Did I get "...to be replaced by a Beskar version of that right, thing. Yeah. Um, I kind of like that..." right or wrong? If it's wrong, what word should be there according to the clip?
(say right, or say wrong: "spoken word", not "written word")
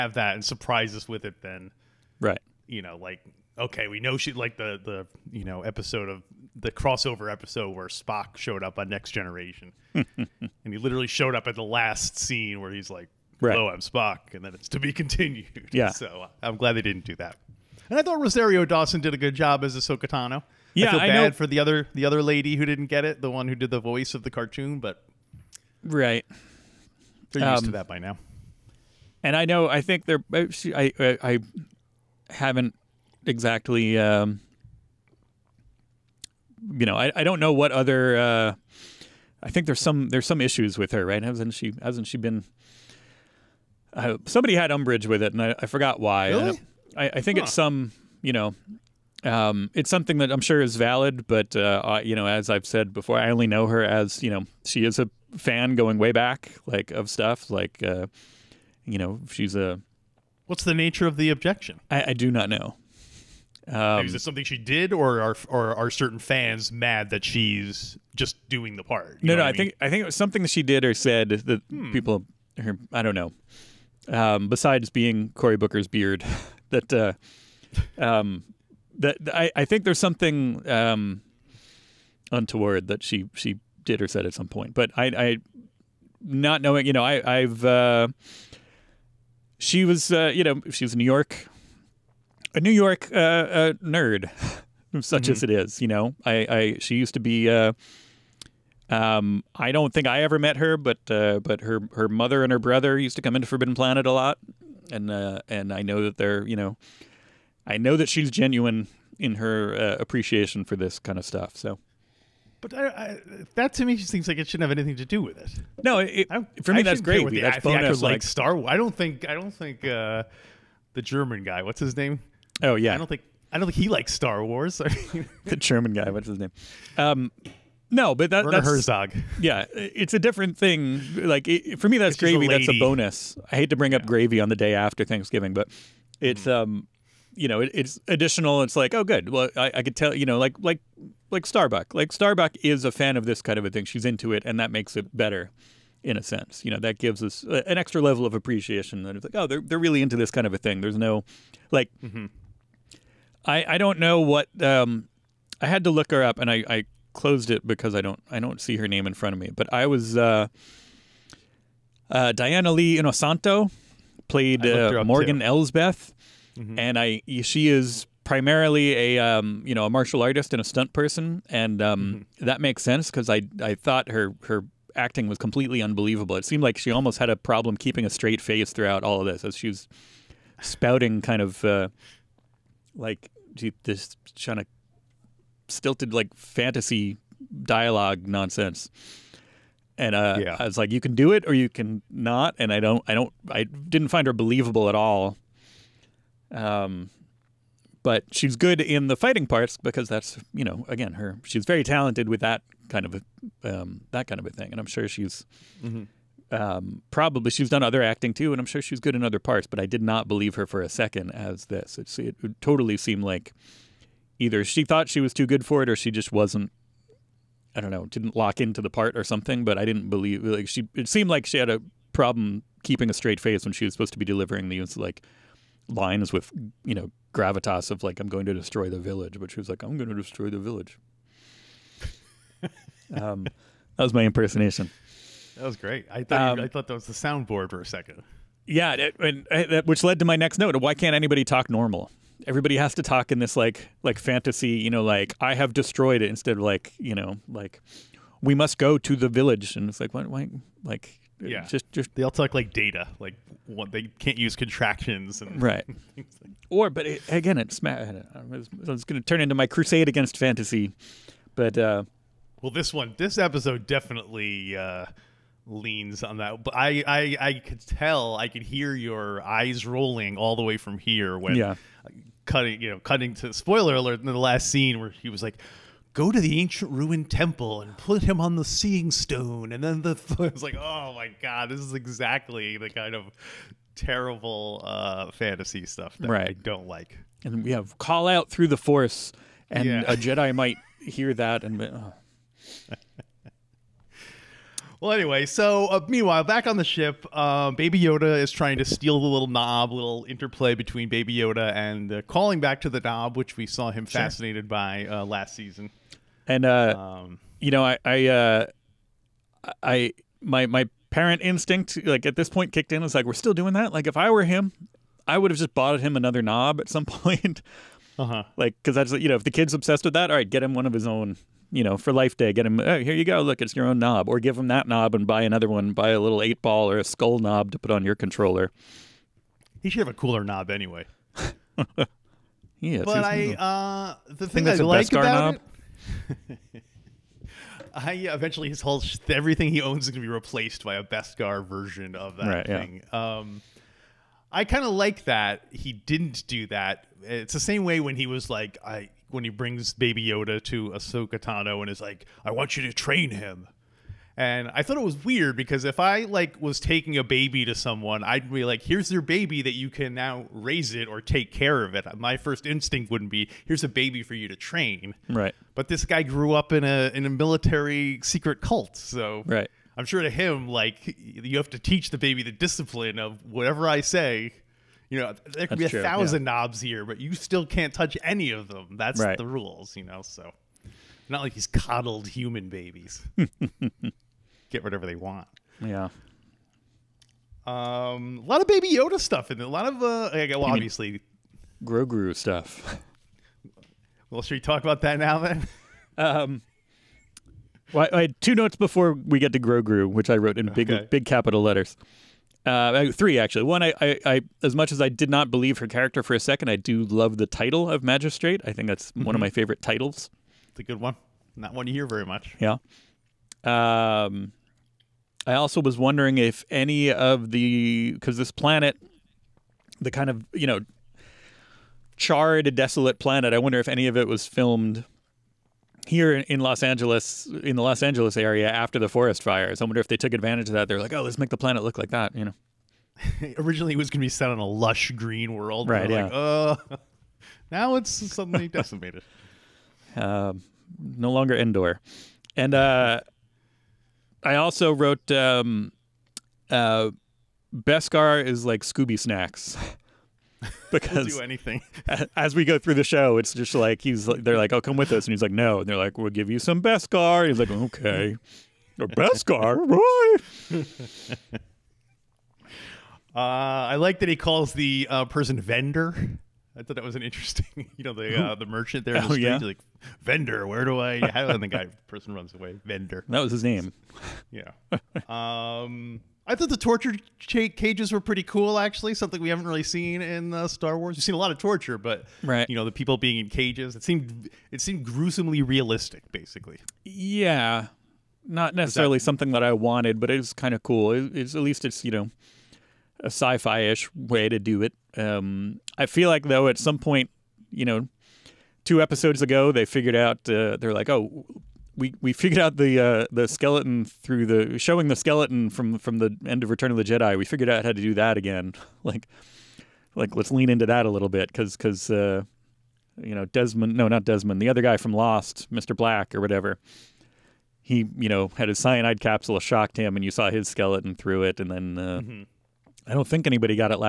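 right.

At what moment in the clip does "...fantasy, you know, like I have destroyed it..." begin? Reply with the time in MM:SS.
04:04.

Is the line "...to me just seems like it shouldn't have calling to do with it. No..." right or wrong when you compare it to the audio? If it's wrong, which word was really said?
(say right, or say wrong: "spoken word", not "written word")
wrong: "anything", not "calling".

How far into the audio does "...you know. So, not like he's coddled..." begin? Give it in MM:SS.
06:19.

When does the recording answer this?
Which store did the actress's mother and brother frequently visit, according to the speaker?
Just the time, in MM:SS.
01:43.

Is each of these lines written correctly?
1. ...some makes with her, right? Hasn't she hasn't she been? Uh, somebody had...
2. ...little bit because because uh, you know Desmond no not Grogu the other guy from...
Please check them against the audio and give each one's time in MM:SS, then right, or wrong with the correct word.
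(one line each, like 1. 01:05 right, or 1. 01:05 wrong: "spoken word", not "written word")
1. 00:40 wrong: "issues", not "makes"
2. 08:31 wrong: "Desmond", not "Grogu".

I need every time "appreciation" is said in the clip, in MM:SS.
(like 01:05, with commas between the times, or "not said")
01:49, 02:28.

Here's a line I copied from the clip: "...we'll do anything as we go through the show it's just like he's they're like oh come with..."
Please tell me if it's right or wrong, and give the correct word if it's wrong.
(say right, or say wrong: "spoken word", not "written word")
right.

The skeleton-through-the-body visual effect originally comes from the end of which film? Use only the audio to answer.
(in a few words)
Return of the Jedi.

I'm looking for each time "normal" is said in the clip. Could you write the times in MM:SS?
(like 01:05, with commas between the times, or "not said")
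04:01.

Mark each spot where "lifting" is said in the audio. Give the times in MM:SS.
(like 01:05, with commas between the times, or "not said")
not said.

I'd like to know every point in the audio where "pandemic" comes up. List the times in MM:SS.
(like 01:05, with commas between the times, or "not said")
not said.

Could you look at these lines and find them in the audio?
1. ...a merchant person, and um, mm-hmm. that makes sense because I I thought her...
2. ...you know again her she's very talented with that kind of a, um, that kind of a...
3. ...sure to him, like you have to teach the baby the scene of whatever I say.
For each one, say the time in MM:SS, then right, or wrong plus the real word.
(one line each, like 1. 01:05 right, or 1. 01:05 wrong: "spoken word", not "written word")
1. 02:50 wrong: "stunt", not "merchant"
2. 03:20 right
3. 06:10 wrong: "discipline", not "scene".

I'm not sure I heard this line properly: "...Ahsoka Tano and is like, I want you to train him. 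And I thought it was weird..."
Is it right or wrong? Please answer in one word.
right.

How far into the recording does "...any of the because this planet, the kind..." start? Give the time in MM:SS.
06:56.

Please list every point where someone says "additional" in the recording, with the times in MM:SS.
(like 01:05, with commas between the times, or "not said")
02:18.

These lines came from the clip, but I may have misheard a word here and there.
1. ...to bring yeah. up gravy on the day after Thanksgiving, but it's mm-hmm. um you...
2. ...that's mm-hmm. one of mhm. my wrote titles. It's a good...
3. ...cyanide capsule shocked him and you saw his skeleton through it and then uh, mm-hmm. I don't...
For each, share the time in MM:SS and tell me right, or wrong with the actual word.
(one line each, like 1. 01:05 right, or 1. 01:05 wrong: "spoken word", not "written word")
1. 02:13 right
2. 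06:48 wrong: "favorite", not "wrote"
3. 08:38 right.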